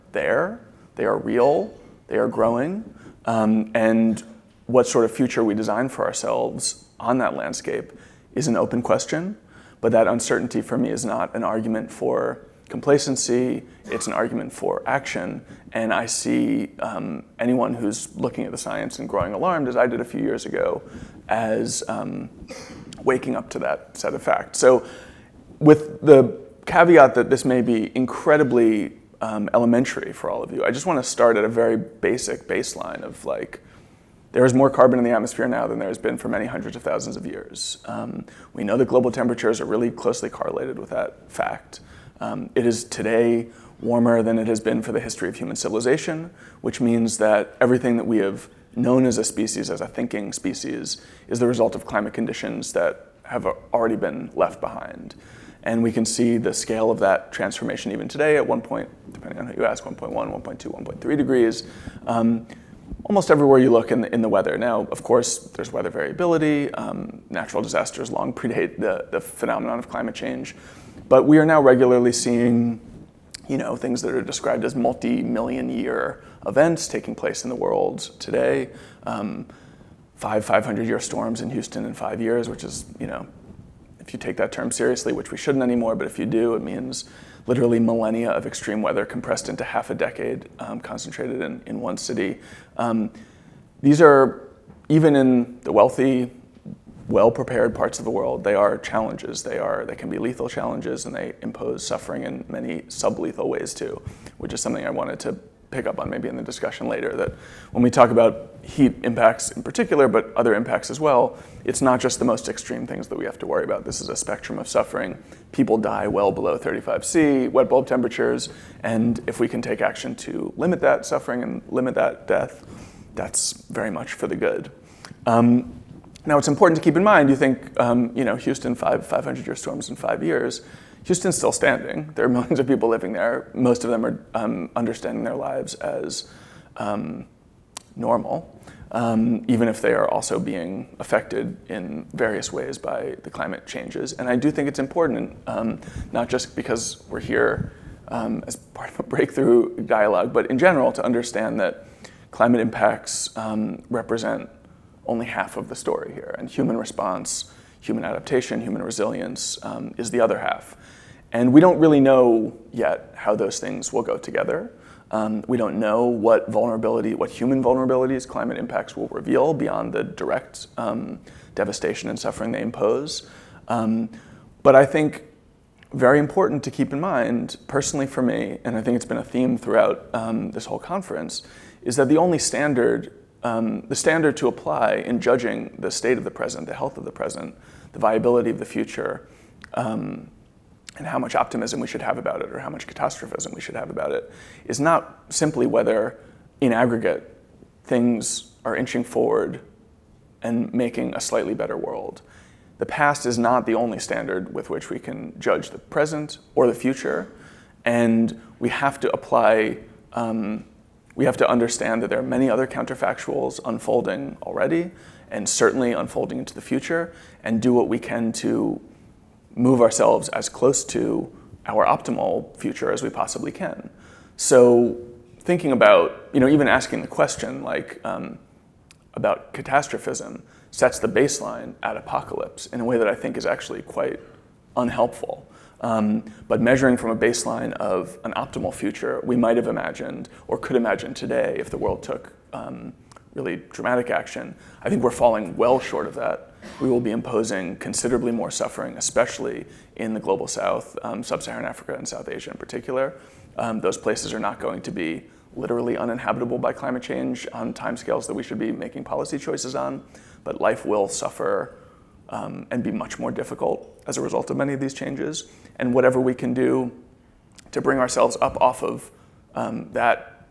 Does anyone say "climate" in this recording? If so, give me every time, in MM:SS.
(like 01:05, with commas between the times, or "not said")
00:51, 01:09, 02:23, 02:32, 02:48, 04:16.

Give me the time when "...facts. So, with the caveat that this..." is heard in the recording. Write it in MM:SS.
00:24.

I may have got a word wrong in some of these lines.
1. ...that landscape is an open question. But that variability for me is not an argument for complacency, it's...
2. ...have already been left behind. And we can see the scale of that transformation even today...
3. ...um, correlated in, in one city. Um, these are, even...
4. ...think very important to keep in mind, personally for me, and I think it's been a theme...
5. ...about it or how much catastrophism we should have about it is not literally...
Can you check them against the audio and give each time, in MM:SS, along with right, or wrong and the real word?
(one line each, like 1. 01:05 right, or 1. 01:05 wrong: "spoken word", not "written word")
1. 00:07 wrong: "uncertainty", not "variability"
2. 00:53 right
3. 01:30 wrong: "concentrated", not "correlated"
4. 02:54 right
5. 03:12 wrong: "simply", not "literally".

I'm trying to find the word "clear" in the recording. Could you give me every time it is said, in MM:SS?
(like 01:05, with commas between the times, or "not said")
not said.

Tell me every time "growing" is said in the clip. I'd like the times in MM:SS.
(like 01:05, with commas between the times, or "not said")
00:02, 00:19.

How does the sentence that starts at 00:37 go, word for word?
Um, we know that global temperatures are really closely correlated with that fact.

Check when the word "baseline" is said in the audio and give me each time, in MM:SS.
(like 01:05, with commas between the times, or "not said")
00:32, 03:51, 03:57.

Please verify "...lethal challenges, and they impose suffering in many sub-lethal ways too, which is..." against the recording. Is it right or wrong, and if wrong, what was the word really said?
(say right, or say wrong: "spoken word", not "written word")
right.